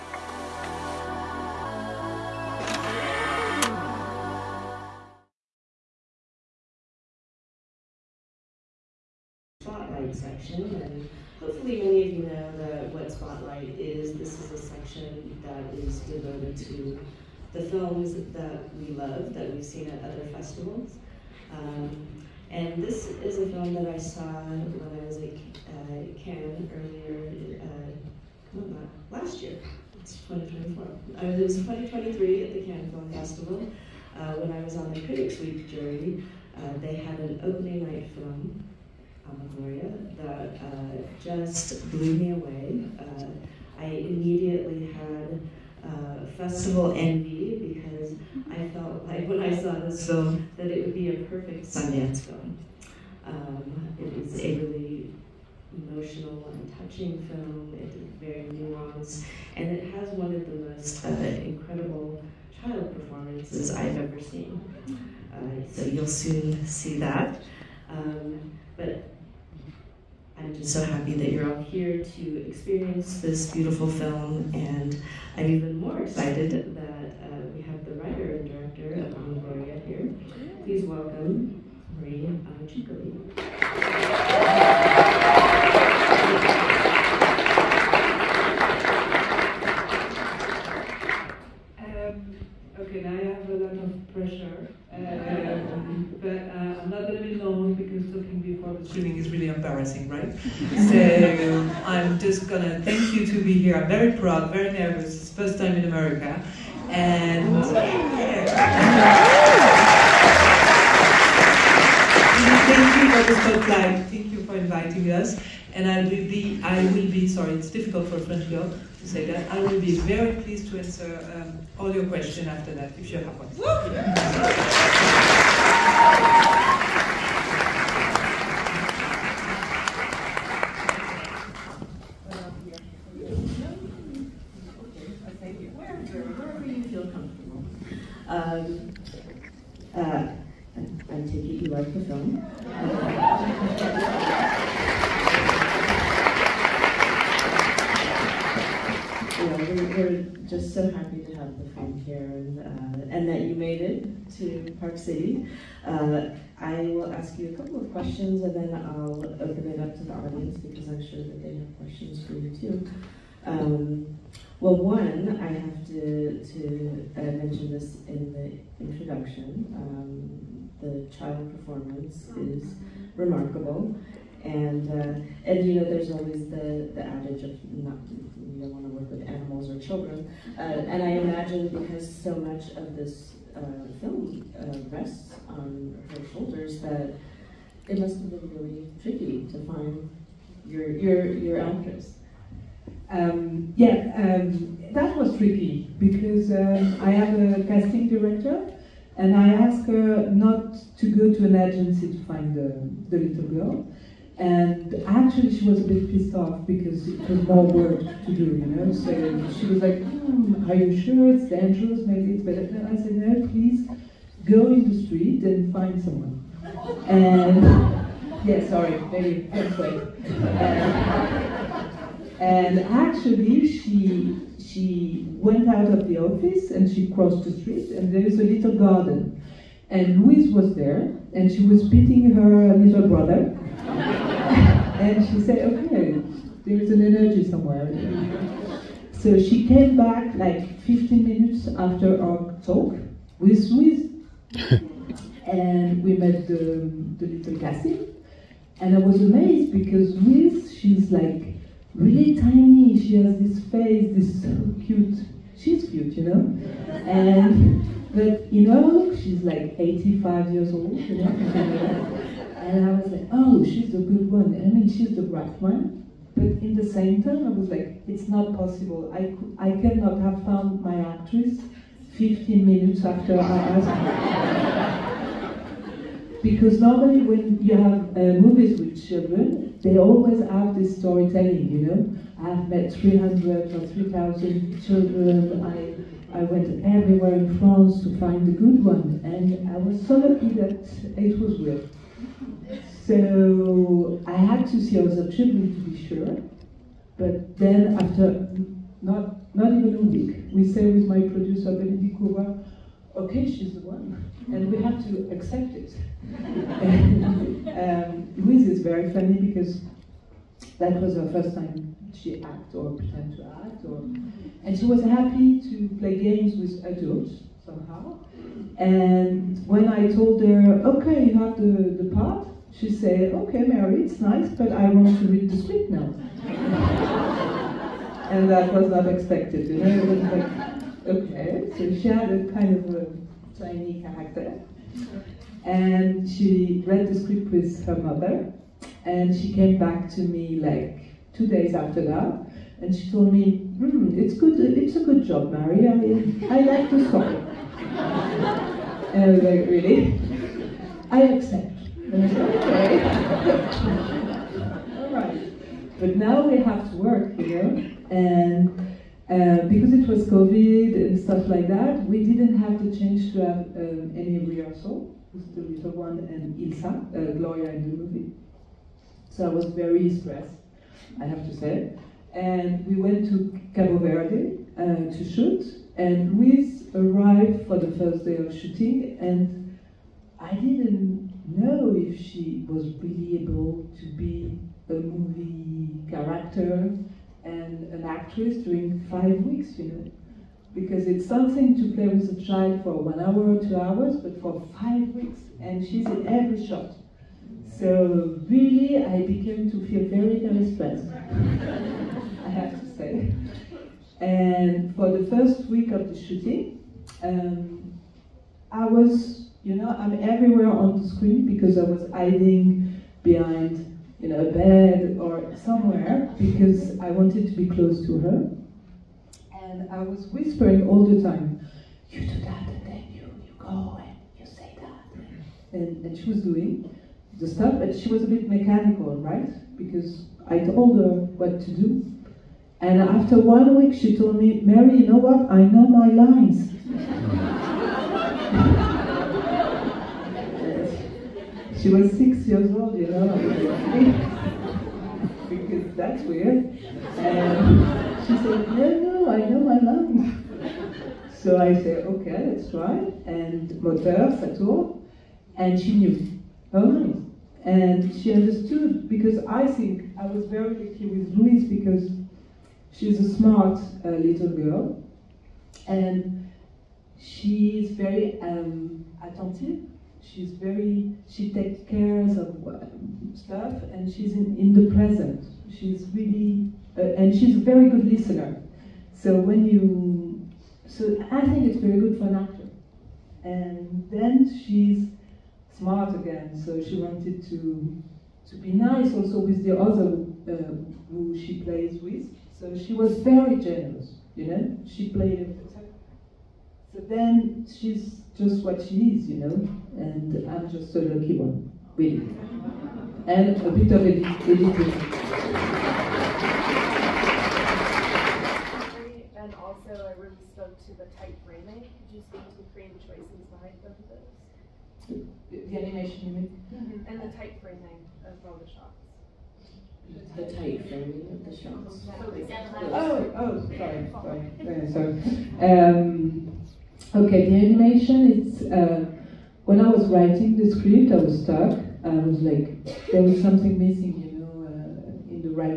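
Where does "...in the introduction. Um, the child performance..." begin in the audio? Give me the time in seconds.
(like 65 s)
168 s.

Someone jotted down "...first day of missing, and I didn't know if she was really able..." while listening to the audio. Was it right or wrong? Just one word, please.
wrong.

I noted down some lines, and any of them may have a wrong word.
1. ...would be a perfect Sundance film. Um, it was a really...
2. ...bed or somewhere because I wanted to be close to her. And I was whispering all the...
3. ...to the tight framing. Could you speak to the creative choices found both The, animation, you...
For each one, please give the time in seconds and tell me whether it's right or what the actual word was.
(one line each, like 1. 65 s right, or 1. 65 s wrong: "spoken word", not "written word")
1. 50 s right
2. 414 s right
3. 510 s wrong: "behind", not "found".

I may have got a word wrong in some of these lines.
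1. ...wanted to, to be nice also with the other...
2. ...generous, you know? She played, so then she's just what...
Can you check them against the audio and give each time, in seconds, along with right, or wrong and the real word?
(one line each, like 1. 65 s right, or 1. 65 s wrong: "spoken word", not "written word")
1. 487 s right
2. 493 s right.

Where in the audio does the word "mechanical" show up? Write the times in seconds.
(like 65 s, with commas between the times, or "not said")
428 s.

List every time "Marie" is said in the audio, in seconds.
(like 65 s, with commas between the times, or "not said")
81 s.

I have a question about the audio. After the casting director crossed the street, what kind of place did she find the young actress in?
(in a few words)
a little garden.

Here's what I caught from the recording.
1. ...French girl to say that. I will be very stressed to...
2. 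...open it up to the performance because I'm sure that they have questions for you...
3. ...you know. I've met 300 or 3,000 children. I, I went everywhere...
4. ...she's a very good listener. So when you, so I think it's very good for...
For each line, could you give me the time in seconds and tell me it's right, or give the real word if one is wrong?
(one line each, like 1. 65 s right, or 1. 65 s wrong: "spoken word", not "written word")
1. 118 s wrong: "pleased", not "stressed"
2. 159 s wrong: "audience", not "performance"
3. 281 s right
4. 477 s right.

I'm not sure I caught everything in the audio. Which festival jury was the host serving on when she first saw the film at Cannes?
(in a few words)
Critics Week.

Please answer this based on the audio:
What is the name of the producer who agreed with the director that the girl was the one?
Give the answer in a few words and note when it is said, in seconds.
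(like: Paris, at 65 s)
Bénédicte Couvreur, at 301 s.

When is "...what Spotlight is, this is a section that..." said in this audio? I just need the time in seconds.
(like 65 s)
12 s.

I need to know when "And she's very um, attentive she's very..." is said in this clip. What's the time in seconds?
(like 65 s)
465 s.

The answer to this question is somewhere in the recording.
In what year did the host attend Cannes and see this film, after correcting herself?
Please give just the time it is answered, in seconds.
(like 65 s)
31 s.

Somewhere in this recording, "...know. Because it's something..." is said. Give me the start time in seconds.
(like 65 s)
389 s.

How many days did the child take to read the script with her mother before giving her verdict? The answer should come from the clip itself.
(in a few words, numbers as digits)
2.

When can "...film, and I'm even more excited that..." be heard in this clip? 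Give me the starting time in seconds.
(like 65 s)
73 s.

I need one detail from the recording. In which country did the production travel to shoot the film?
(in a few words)
Cabo Verde.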